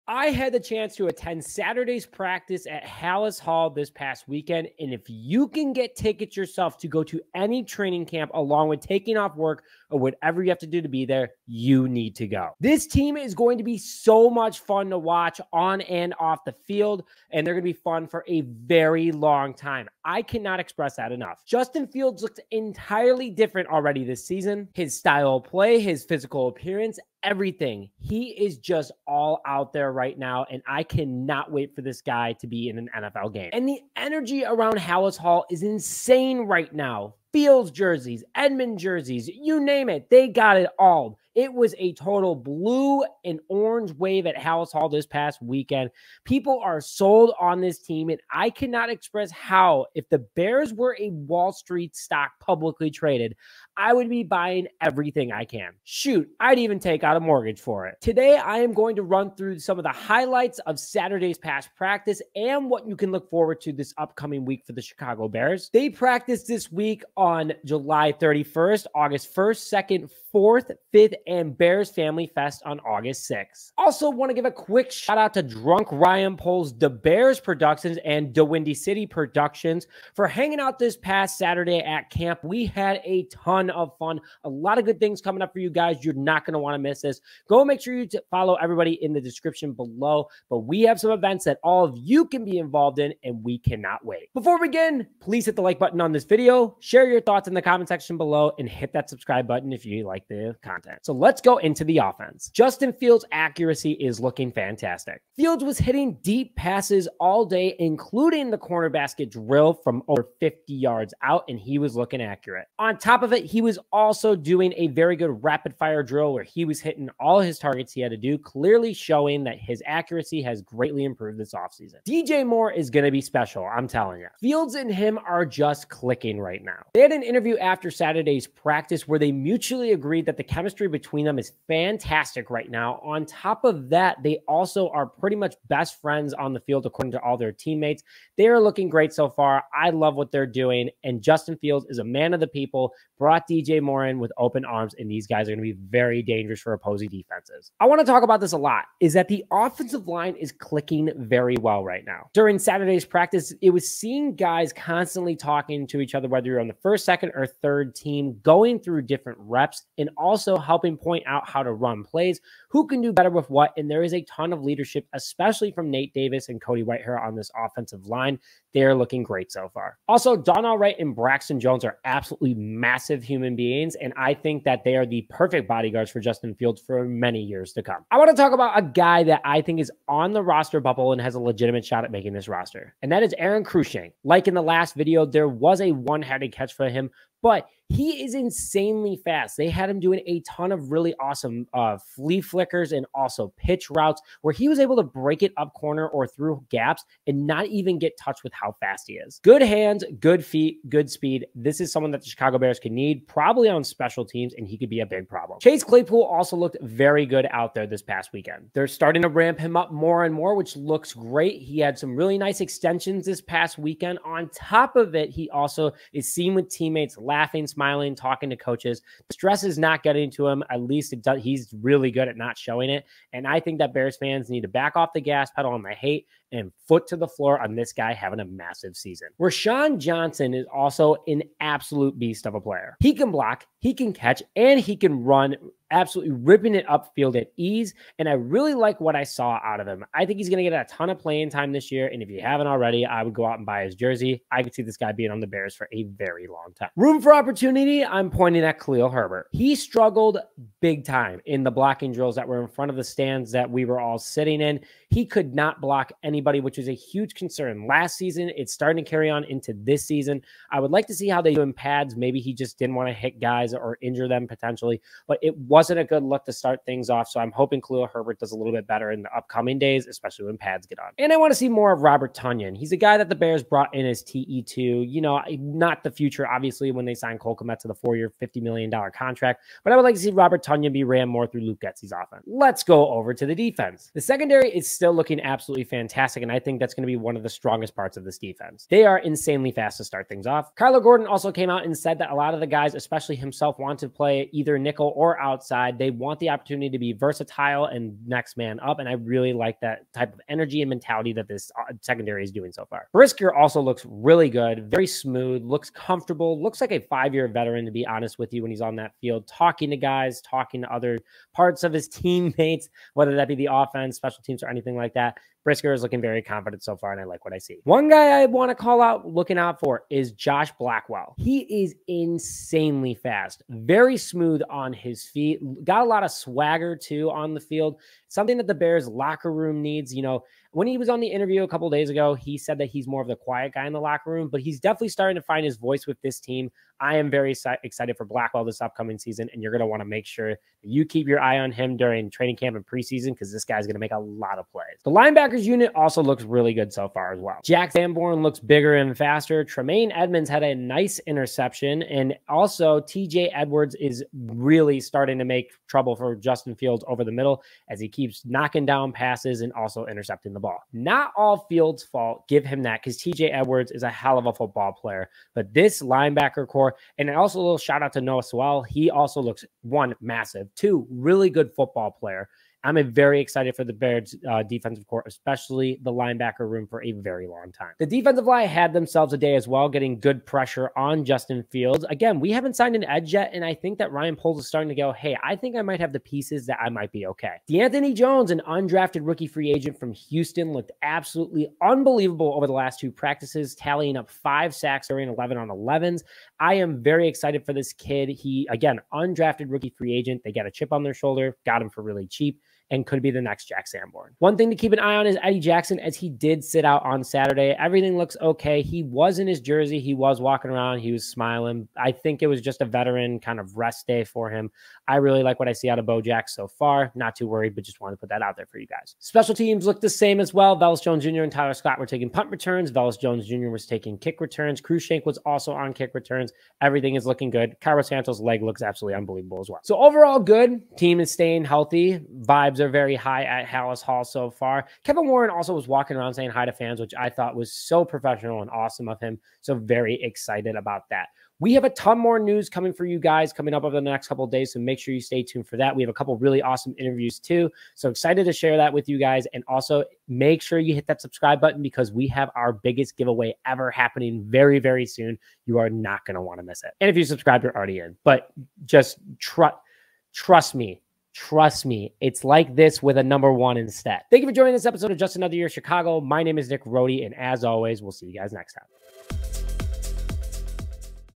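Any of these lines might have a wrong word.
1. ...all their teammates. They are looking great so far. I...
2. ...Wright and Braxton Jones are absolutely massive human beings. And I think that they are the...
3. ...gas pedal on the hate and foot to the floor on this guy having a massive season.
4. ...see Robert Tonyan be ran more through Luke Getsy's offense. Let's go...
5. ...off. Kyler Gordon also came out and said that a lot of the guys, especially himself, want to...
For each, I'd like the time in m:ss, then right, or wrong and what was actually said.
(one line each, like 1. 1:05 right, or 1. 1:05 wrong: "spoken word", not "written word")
1. 2:17 right
2. 2:50 right
3. 3:45 right
4. 4:40 right
5. 4:50 right.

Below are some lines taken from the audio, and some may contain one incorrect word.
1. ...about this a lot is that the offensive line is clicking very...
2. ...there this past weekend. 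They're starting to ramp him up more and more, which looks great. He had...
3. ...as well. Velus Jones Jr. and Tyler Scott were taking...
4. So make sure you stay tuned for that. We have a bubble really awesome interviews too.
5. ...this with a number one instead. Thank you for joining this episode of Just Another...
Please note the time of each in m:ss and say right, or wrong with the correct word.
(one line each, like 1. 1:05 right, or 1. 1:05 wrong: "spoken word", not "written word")
1. 2:28 right
2. 3:27 right
3. 7:00 right
4. 7:24 wrong: "couple", not "bubble"
5. 7:42 right.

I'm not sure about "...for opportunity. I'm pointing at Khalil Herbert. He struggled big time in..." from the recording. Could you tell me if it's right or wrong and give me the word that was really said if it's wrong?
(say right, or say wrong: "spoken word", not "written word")
right.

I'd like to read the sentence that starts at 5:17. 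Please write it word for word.
One guy I want to call out, looking out for, is Josh Blackwell.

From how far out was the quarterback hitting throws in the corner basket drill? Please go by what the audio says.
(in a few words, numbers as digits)
Over 50 yards.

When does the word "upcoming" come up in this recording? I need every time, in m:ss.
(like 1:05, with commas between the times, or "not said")
1:03, 4:29, 5:38.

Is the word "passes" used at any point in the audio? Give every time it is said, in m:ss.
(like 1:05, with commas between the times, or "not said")
1:46, 5:59.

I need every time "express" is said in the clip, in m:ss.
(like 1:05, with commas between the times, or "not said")
0:20, 0:48.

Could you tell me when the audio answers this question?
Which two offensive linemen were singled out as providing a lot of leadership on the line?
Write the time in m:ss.
2:45.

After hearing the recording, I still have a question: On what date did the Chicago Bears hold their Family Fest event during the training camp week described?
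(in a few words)
August 6.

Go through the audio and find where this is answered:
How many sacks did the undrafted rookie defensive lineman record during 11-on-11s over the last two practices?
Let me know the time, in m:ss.
6:34.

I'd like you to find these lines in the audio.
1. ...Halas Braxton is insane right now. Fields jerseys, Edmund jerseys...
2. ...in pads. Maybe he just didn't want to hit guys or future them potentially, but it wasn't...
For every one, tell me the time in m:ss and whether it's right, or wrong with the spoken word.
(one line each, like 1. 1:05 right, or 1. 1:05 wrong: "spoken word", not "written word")
1. 0:34 wrong: "Hall", not "Braxton"
2. 4:21 wrong: "injure", not "future".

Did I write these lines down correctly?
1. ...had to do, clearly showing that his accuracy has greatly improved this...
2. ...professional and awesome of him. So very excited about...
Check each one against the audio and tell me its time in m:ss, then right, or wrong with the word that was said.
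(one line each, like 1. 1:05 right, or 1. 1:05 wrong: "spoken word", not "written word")
1. 1:58 right
2. 7:18 right.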